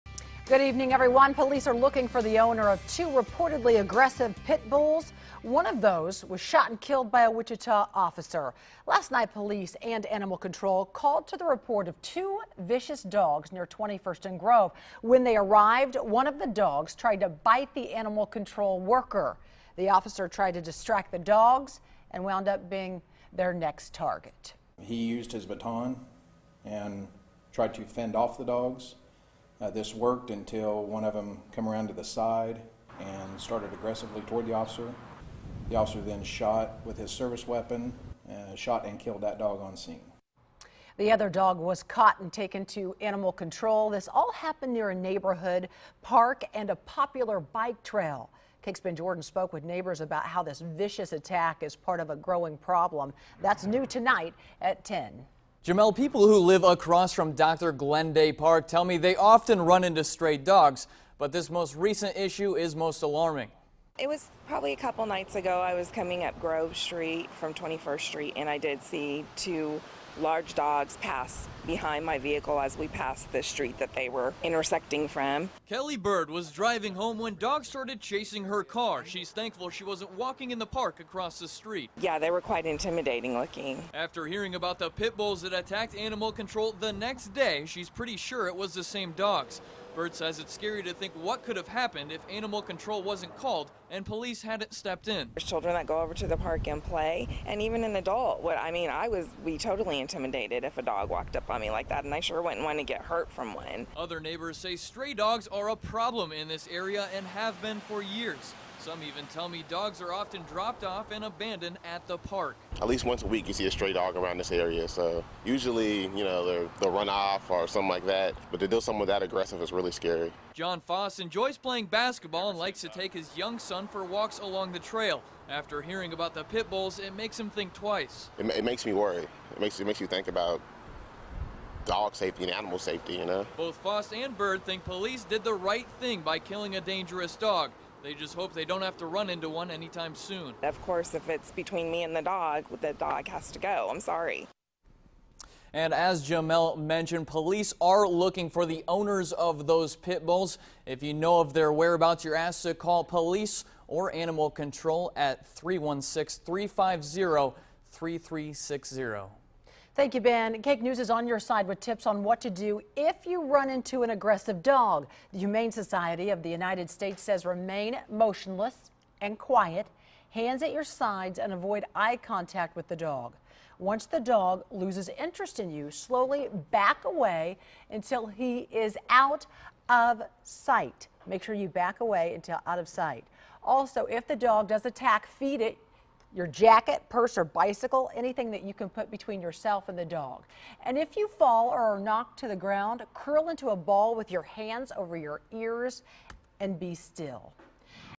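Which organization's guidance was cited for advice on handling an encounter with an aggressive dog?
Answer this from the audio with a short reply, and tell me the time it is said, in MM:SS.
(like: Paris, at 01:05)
Humane Society of the United States, at 02:45.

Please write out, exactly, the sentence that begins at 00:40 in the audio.
The other dog was caught and taken to animal control.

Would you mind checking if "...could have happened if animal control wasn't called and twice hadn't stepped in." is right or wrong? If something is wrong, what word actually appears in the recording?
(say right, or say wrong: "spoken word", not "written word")
wrong: "police", not "twice".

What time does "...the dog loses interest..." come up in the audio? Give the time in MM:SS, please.
02:54.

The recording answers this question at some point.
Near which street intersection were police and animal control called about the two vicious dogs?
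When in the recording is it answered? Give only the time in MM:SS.
00:13.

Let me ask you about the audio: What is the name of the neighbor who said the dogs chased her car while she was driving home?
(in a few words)
Kelly Bird.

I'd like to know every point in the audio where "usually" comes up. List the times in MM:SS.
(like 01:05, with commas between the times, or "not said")
01:55.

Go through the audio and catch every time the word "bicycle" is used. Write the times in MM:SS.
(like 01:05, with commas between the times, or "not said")
03:07.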